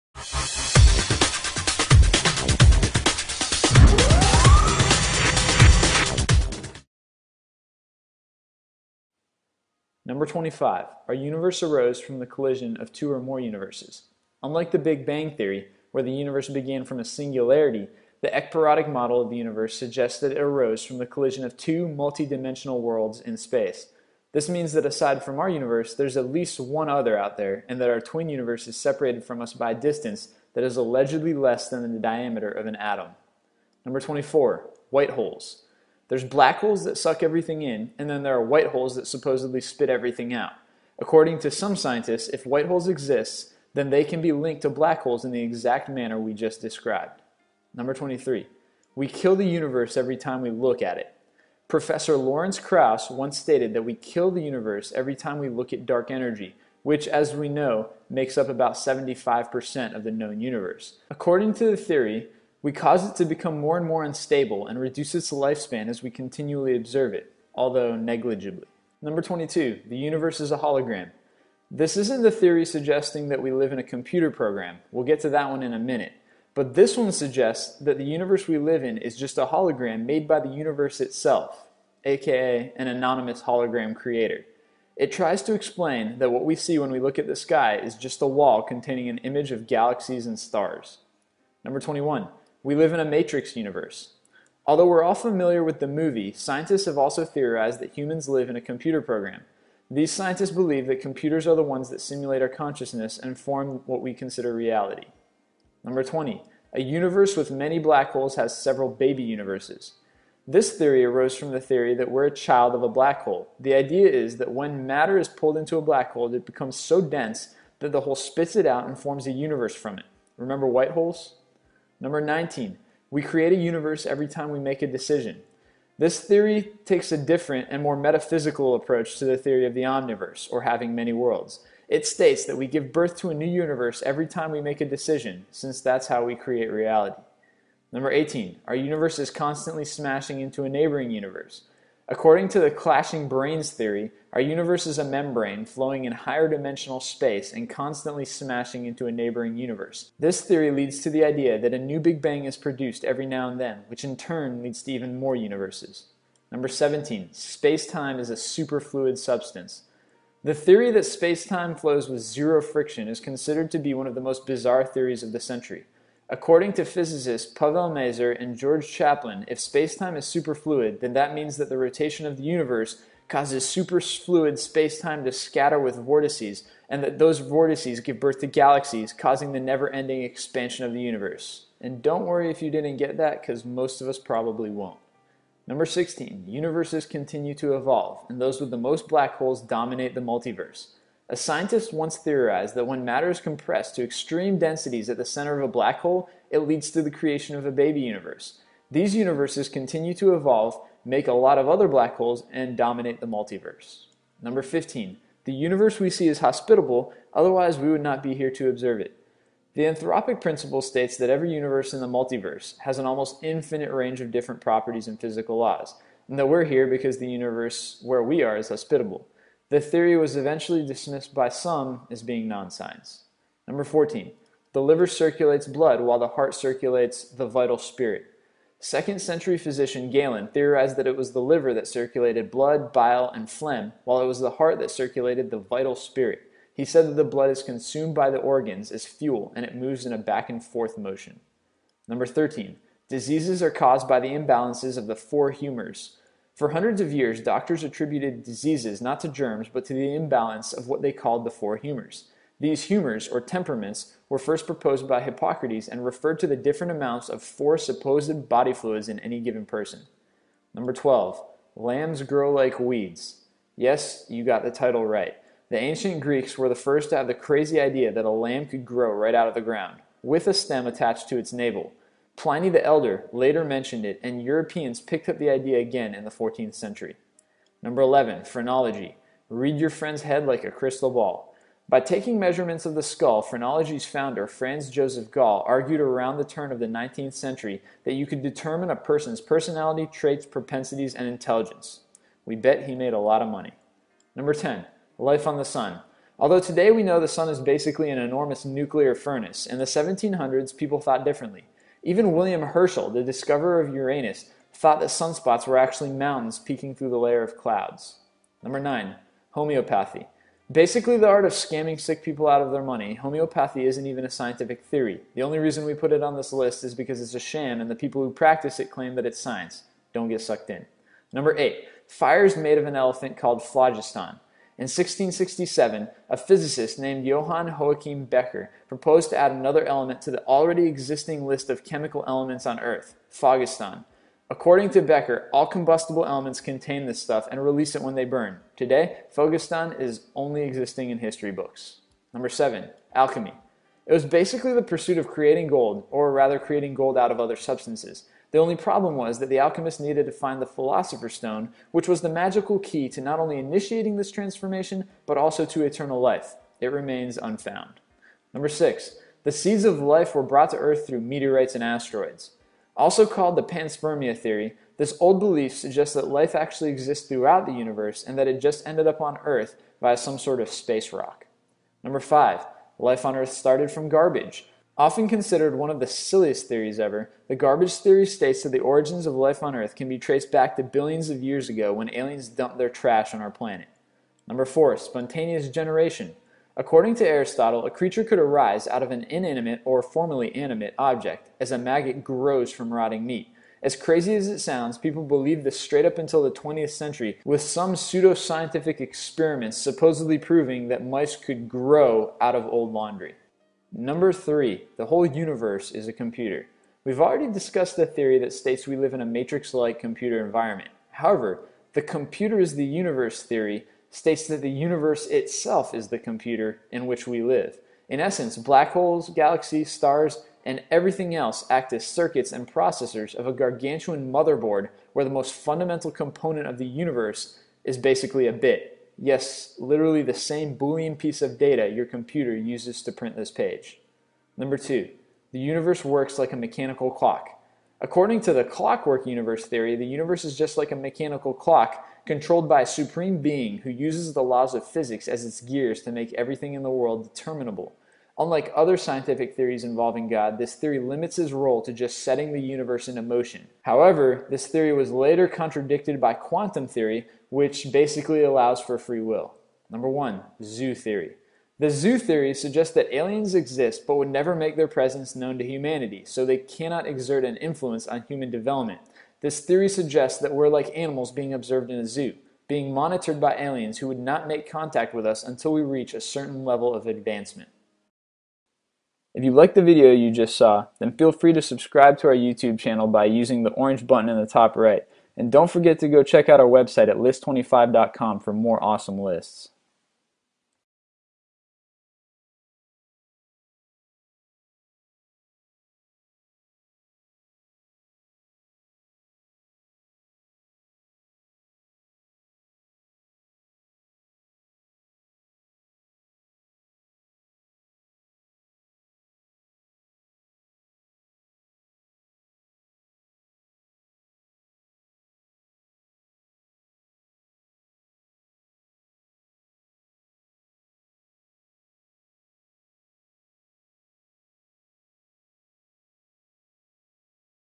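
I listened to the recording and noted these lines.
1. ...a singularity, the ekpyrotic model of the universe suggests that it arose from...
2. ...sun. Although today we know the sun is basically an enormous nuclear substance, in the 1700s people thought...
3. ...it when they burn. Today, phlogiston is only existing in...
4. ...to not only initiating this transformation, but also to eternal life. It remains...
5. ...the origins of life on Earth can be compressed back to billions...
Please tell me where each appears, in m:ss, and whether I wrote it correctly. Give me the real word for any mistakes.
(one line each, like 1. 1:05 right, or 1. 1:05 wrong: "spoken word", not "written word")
1. 0:16 right
2. 4:55 wrong: "furnace", not "substance"
3. 5:37 right
4. 5:53 right
5. 6:18 wrong: "traced", not "compressed".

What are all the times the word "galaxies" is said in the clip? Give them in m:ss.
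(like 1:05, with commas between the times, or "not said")
1:29, 2:58, 6:59.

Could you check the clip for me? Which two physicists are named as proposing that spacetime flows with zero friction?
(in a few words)
Pavel Mazur and George Chapline.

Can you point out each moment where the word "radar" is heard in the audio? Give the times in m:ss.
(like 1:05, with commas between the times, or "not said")
not said.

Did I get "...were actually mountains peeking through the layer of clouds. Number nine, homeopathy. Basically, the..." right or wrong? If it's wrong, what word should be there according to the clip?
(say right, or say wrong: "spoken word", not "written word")
right.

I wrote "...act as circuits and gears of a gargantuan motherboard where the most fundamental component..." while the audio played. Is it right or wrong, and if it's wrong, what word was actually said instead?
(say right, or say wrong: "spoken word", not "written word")
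wrong: "processors", not "gears".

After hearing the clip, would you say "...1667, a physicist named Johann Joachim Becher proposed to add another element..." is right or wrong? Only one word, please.
right.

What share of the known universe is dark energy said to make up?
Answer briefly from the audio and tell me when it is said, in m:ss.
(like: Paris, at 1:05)
75%, at 0:58.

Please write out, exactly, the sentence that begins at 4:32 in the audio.
Pliny the Elder later mentioned it, and Europeans picked up the idea again in the 14th century.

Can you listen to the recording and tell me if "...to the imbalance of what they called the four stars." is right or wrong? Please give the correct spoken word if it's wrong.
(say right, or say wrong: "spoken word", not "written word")
wrong: "humors", not "stars".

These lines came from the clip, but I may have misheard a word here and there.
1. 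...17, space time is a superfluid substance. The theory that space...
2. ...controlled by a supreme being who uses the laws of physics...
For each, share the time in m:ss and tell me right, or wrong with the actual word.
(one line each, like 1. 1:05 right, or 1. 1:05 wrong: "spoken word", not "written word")
1. 2:36 right
2. 7:22 right.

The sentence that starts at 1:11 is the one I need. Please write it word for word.
This isn't the theory suggesting that we live in a computer program.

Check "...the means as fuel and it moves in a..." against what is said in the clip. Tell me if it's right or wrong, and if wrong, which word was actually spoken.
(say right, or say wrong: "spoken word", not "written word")
wrong: "organs", not "means".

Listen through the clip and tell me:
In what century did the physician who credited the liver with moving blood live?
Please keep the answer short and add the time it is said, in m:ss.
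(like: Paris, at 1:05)
second century, at 3:48.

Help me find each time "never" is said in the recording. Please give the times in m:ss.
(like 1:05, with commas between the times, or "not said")
2:59, 7:44.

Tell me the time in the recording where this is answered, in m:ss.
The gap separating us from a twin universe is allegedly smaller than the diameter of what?
0:32.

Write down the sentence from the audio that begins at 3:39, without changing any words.
The theory was eventually dismissed by some as being non-science.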